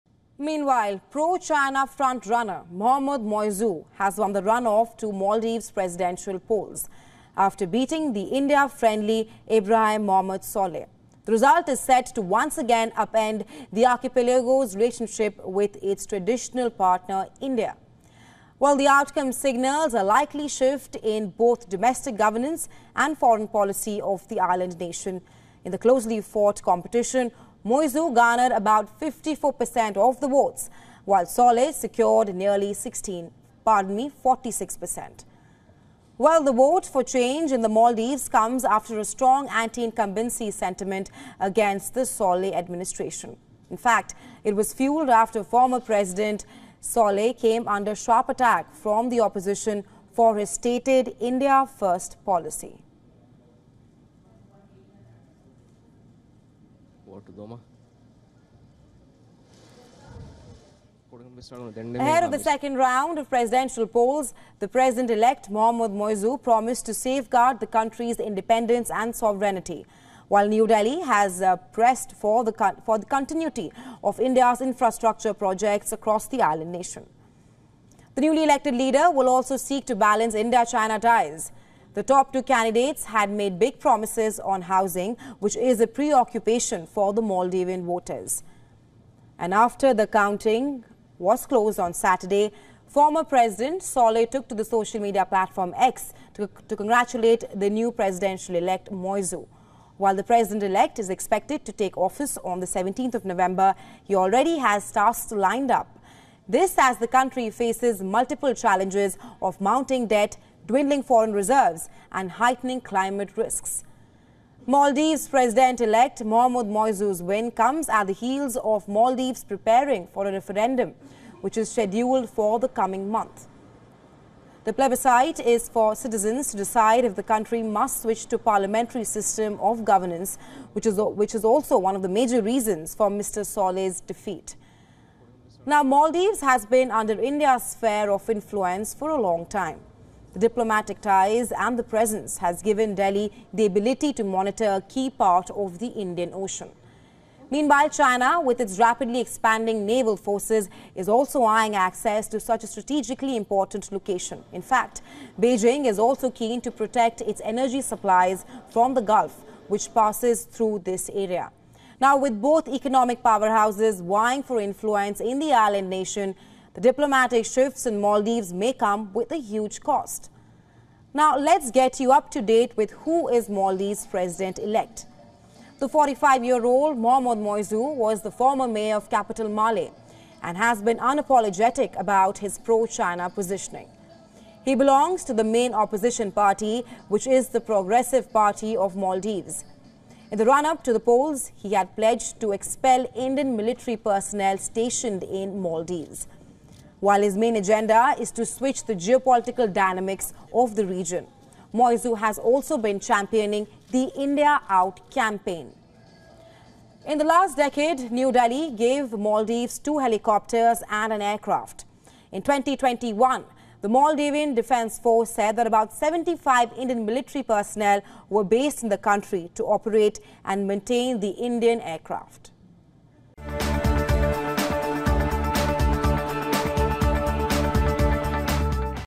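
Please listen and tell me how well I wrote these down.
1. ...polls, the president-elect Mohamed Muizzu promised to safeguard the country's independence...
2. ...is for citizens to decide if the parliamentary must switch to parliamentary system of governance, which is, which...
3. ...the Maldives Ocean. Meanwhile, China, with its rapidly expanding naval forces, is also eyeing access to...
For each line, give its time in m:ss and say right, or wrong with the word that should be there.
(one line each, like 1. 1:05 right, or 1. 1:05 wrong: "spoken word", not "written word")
1. 1:03 right
2. 2:05 wrong: "country", not "parliamentary"
3. 2:25 wrong: "Indian", not "Maldives".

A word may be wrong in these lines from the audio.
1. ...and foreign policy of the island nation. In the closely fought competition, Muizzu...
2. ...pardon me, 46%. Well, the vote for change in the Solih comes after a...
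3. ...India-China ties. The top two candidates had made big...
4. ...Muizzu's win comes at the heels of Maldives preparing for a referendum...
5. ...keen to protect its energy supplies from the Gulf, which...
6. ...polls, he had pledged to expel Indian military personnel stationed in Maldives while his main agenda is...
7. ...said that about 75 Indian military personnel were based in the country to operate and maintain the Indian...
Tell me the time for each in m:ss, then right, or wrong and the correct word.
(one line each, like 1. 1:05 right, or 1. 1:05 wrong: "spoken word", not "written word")
1. 0:22 right
2. 0:33 wrong: "Maldives", not "Solih"
3. 1:20 right
4. 1:56 right
5. 2:36 right
6. 3:10 right
7. 3:35 right.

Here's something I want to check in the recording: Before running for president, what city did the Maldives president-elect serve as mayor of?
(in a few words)
Male.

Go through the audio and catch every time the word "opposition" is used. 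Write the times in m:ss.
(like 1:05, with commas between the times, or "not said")
0:49, 3:05.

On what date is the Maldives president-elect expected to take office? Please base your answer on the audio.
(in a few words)
17th of November.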